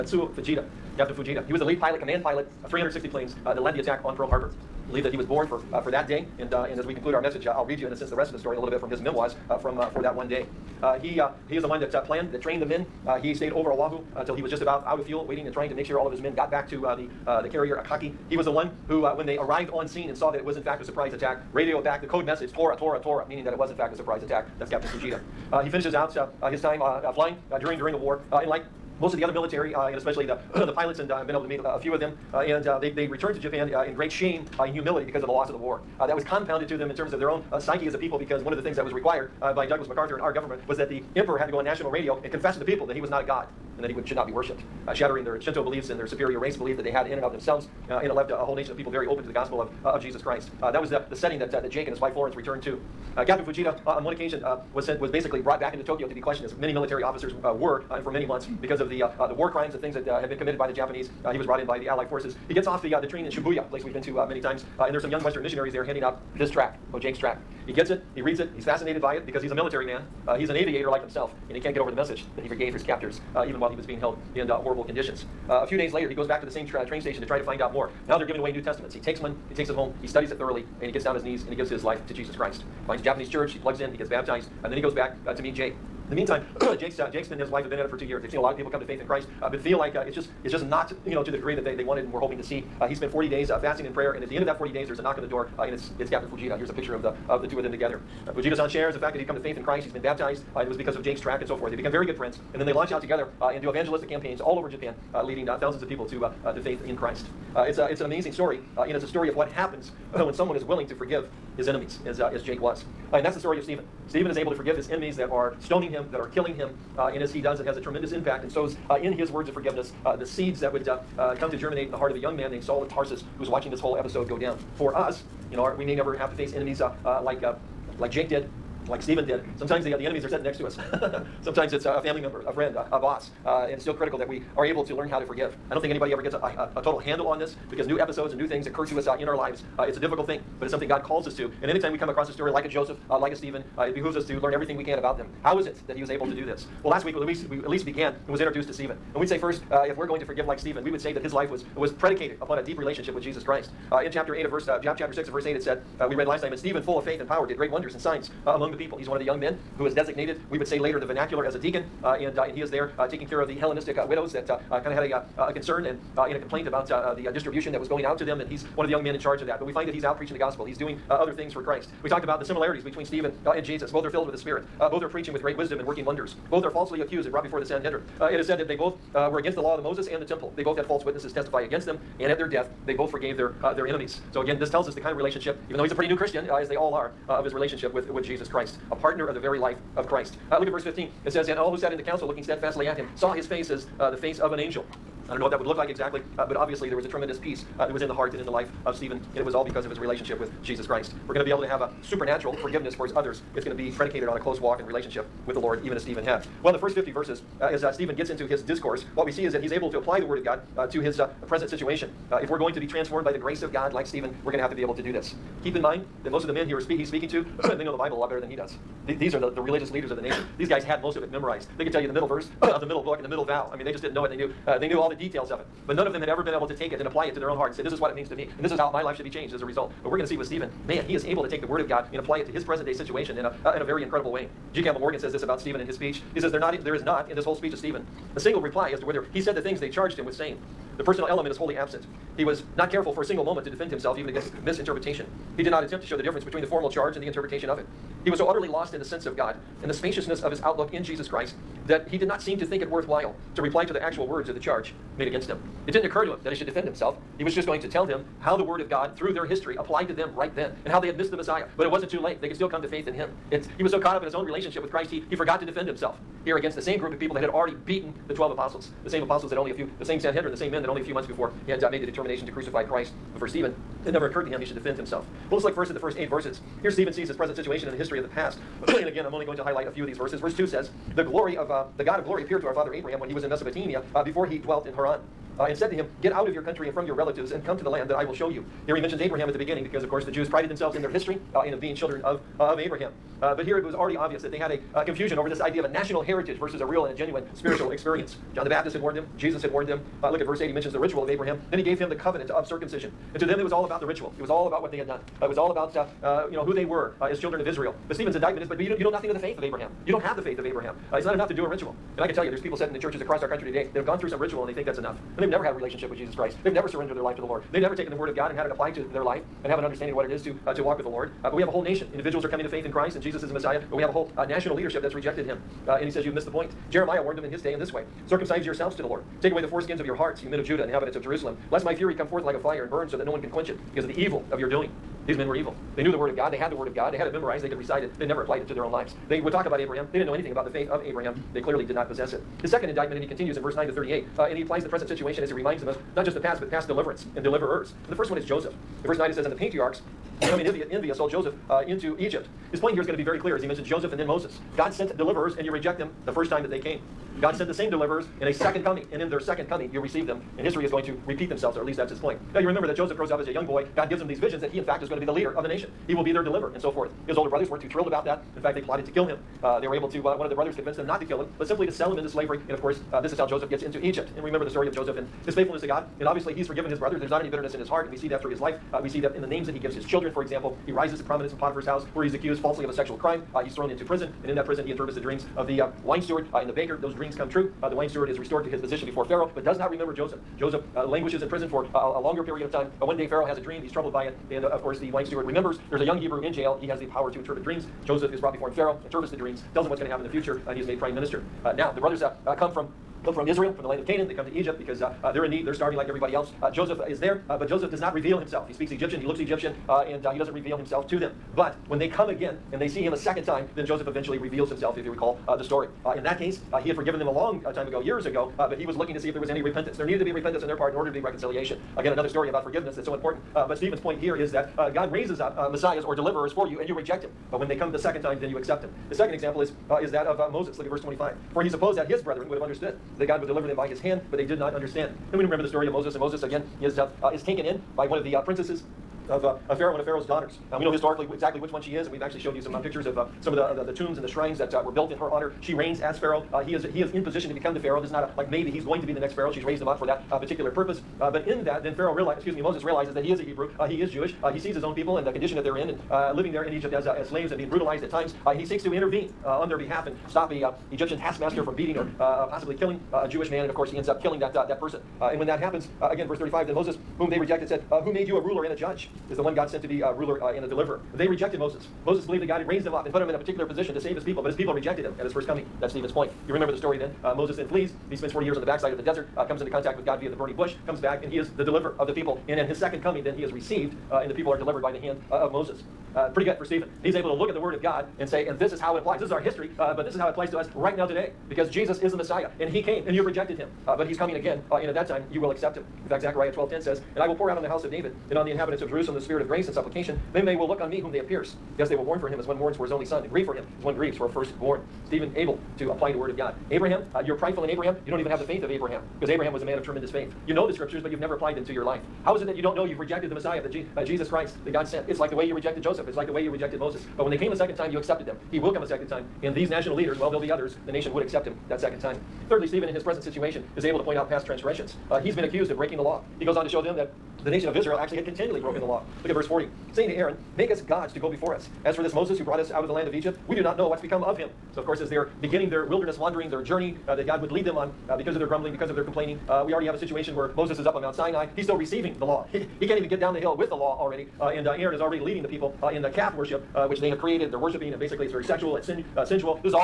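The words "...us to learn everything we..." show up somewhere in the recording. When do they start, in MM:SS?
02:24.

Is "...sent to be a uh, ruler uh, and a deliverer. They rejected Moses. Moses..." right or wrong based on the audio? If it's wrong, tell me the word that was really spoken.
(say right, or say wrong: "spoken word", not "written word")
right.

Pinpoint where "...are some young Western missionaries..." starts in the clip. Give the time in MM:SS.
01:04.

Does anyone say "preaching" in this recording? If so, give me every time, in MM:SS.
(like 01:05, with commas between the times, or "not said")
02:50, 02:55.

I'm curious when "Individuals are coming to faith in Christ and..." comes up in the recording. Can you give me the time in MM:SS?
05:22.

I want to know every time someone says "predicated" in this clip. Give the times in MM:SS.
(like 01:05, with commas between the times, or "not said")
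02:31, 03:23.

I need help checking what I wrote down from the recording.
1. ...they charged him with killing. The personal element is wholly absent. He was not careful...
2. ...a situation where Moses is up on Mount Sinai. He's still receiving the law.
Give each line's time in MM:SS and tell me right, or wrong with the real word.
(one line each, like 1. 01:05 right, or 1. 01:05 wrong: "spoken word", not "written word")
1. 03:59 wrong: "saying", not "killing"
2. 08:59 right.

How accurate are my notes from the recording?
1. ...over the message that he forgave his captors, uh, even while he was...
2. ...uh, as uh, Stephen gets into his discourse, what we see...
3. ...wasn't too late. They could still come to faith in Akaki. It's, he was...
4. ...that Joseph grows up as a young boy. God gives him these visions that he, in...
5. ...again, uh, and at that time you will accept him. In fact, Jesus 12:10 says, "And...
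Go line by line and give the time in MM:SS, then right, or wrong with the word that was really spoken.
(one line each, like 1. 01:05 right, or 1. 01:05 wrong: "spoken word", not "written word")
1. 01:11 right
2. 03:27 right
3. 04:21 wrong: "Him", not "Akaki"
4. 06:02 right
5. 08:14 wrong: "Zechariah", not "Jesus".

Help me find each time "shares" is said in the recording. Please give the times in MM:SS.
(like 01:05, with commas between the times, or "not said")
01:38.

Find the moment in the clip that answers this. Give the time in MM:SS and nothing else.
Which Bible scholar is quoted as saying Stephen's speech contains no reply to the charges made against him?
03:54.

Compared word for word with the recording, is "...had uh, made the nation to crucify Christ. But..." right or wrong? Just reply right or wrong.
wrong.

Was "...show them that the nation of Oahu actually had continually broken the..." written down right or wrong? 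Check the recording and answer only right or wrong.
wrong.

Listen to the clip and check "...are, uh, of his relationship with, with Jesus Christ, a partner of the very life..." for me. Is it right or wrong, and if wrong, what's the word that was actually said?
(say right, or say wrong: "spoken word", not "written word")
right.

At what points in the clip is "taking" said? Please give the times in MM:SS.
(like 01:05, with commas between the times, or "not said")
02:43.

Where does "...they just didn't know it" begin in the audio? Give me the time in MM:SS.
03:43.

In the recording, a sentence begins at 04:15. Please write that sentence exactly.
It didn't occur to him that he should defend himself.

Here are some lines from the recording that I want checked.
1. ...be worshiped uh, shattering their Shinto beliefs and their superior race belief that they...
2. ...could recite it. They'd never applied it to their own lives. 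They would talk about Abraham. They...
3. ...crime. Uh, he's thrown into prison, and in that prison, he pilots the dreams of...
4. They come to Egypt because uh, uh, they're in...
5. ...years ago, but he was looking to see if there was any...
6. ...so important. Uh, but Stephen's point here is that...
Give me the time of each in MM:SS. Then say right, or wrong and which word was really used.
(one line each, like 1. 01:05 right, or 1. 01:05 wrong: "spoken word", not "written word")
1. 00:44 right
2. 05:37 right
3. 06:23 wrong: "interprets", not "pilots"
4. 06:44 right
5. 06:58 right
6. 07:03 right.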